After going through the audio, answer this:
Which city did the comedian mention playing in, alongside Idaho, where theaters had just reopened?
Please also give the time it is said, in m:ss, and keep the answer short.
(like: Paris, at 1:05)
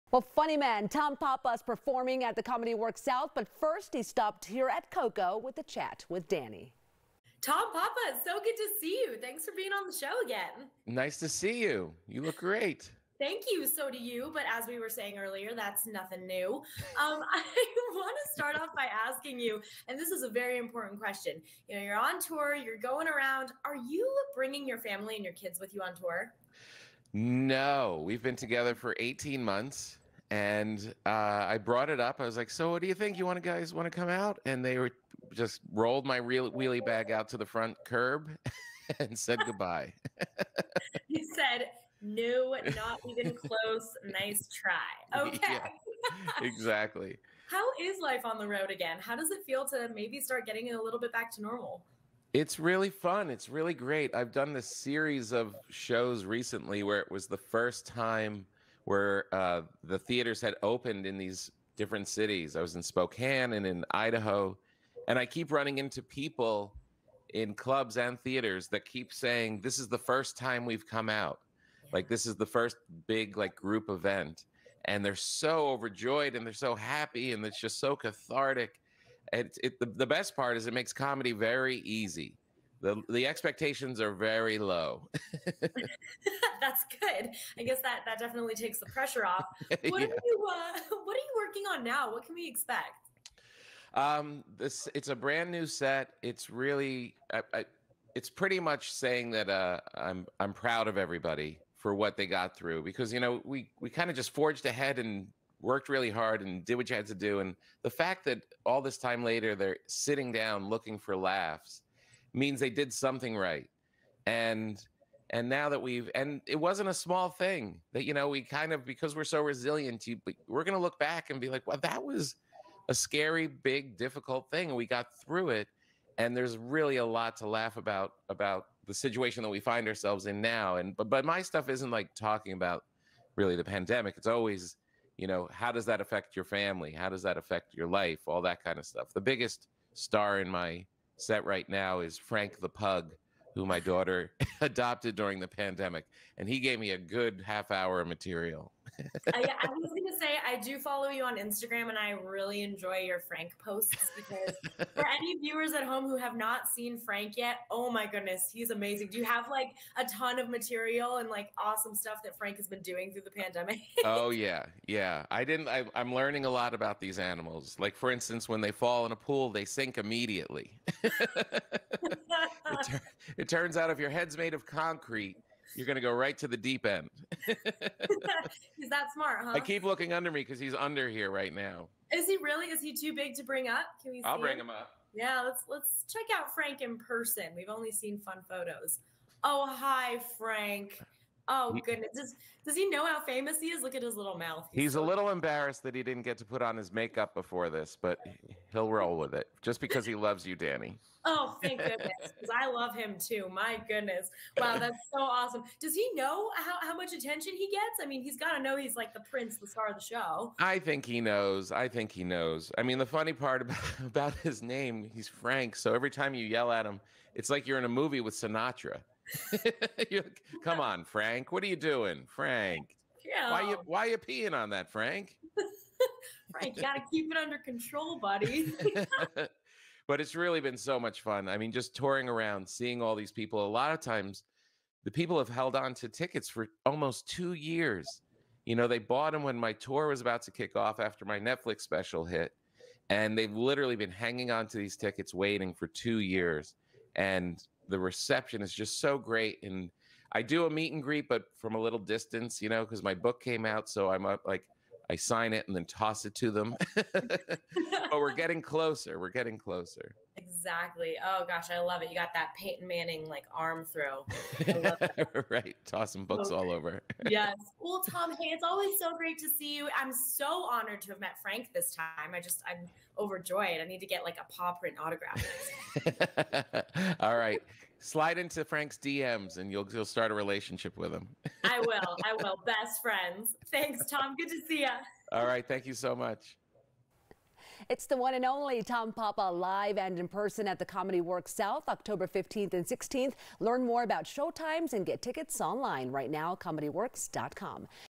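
Spokane, at 1:02.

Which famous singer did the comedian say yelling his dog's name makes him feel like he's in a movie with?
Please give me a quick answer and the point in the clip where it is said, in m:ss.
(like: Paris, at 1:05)
Sinatra, at 3:38.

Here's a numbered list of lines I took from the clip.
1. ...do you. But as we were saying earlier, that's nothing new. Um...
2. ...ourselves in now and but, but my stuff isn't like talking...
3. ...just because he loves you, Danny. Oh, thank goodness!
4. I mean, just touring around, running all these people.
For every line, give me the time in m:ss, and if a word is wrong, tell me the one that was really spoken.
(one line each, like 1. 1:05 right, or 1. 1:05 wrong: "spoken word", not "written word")
1. 0:13 right
2. 2:09 right
3. 3:19 right
4. 3:51 wrong: "seeing", not "running".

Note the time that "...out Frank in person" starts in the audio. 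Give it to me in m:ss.
3:06.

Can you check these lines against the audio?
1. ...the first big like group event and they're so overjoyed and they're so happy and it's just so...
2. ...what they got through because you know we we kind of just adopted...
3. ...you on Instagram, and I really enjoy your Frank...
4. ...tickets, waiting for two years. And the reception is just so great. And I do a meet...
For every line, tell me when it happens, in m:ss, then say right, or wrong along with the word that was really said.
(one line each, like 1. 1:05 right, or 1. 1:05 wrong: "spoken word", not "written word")
1. 1:12 right
2. 1:41 wrong: "forged", not "adopted"
3. 2:31 right
4. 4:04 right.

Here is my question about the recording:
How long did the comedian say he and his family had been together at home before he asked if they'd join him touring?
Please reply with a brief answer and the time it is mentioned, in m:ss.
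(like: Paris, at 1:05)
18 months, at 0:28.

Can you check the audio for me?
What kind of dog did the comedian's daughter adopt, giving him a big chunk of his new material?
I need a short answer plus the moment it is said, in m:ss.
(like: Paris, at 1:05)
Pug, at 2:22.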